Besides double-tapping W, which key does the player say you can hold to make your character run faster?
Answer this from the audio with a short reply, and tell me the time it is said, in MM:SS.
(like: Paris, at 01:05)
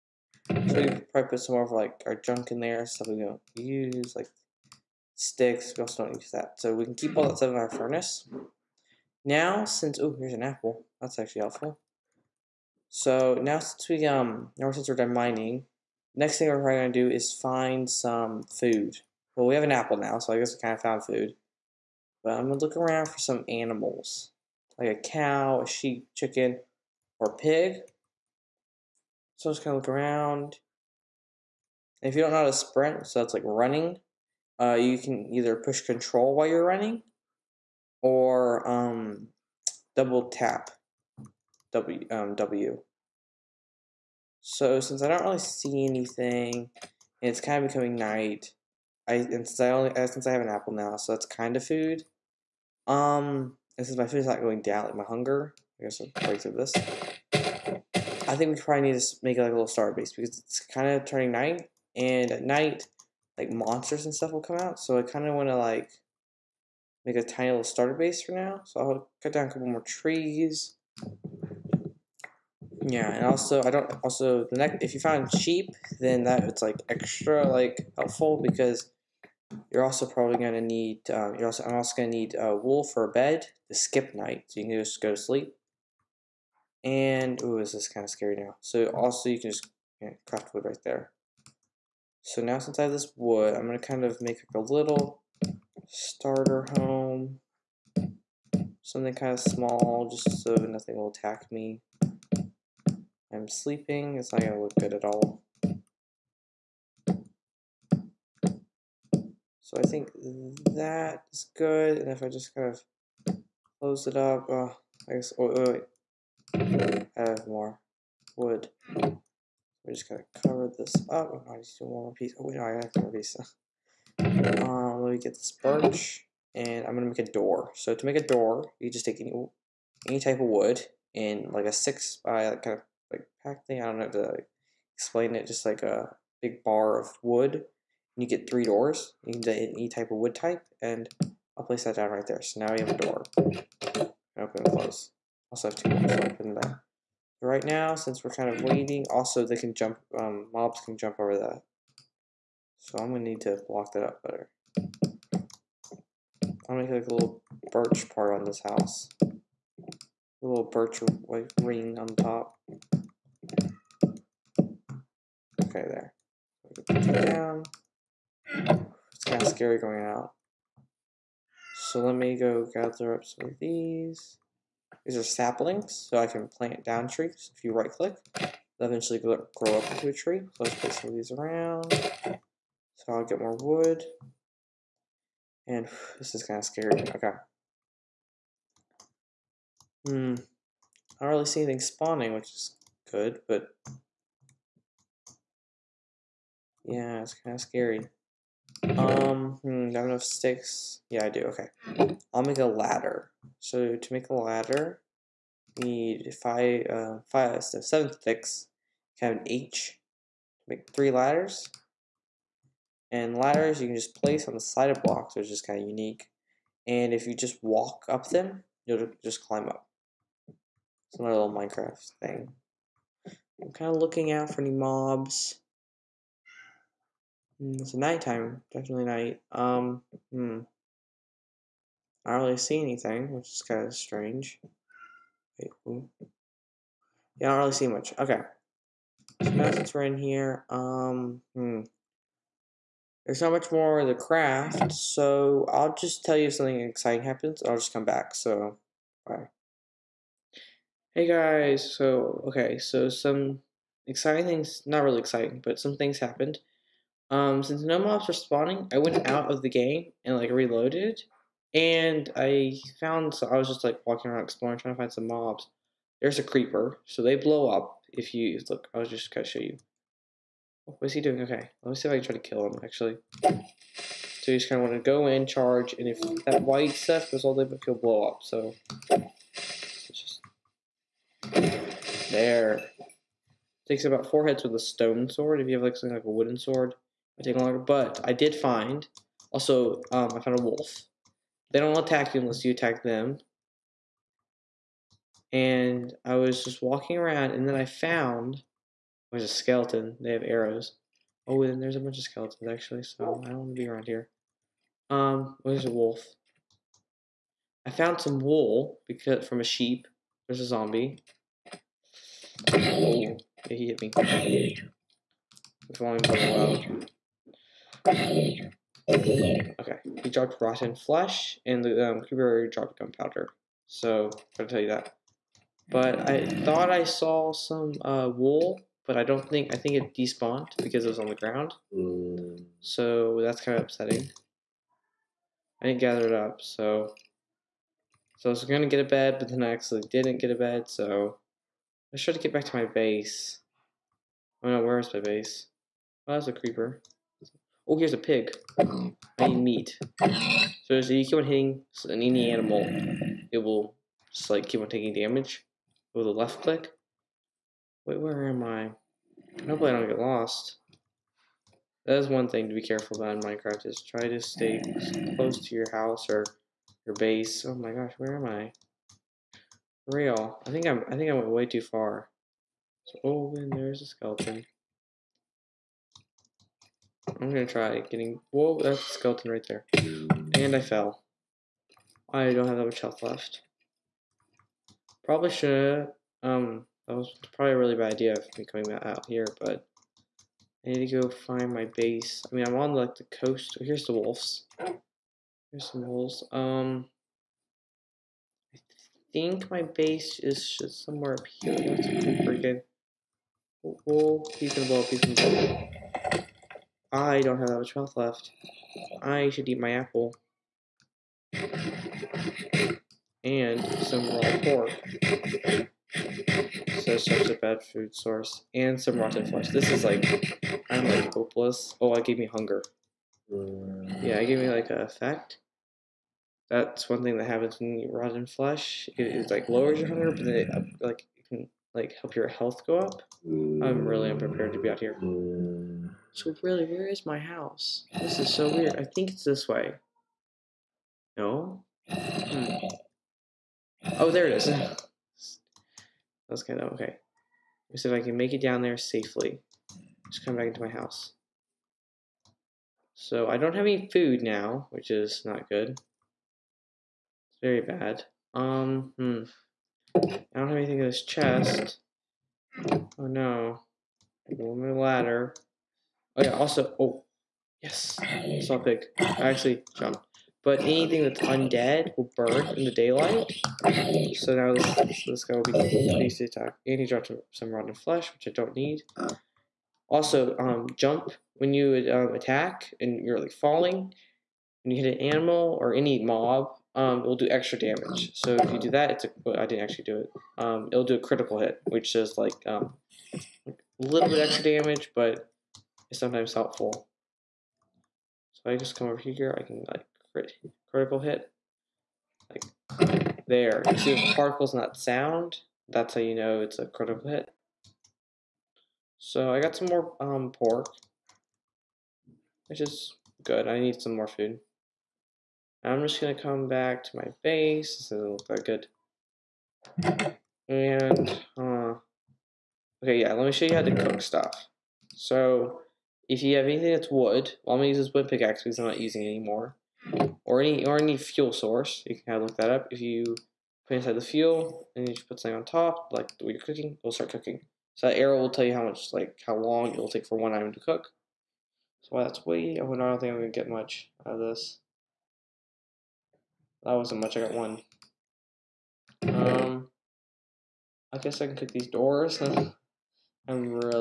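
control, at 00:35.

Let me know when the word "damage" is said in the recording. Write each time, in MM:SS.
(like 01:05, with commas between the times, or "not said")
05:55, 08:07, 08:14.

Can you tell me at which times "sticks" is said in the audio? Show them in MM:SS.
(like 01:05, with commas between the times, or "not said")
00:05, 03:20, 03:28.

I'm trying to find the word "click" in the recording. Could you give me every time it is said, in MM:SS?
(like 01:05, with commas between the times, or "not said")
02:57, 05:56.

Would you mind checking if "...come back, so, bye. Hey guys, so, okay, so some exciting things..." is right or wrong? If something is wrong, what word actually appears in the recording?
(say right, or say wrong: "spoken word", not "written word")
right.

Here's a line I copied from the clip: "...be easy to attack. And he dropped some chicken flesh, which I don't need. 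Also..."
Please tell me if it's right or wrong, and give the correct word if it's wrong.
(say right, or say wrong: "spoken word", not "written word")
wrong: "rotten", not "chicken".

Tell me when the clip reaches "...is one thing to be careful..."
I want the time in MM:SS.
06:02.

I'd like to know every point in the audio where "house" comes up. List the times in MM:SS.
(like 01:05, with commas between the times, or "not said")
02:38, 06:05, 07:17, 07:30.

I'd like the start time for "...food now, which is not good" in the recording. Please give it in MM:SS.
07:34.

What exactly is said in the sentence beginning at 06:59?
This is like, I'm like hopeless.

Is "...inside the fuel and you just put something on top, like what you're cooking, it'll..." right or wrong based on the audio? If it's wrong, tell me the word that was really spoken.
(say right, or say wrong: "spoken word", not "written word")
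right.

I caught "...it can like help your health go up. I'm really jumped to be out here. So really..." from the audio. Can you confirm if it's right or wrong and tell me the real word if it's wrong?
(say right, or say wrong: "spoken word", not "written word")
wrong: "unprepared", not "jumped".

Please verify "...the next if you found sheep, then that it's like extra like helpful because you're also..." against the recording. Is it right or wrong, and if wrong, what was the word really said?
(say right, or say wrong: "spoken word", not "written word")
right.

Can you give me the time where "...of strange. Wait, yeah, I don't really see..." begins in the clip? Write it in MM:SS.
03:53.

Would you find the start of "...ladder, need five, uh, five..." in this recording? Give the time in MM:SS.
03:24.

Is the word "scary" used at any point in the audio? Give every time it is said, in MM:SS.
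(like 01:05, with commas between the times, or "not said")
01:28, 02:49, 03:06, 03:17.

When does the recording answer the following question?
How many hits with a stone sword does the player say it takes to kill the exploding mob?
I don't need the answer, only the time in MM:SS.
04:44.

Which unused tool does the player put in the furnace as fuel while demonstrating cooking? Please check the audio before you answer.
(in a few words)
wood pickaxe.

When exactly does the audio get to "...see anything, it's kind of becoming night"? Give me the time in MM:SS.
00:45.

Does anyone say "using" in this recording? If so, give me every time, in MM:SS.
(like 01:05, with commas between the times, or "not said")
08:49.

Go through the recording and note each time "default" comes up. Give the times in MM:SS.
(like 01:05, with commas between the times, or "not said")
not said.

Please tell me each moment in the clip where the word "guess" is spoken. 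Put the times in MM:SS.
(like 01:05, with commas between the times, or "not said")
00:20, 00:55, 01:55, 09:11.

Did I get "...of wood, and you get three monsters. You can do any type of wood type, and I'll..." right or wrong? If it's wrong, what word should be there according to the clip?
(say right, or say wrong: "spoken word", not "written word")
wrong: "doors", not "monsters".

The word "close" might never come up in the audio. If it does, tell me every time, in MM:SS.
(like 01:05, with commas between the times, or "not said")
01:53, 02:24, 06:05.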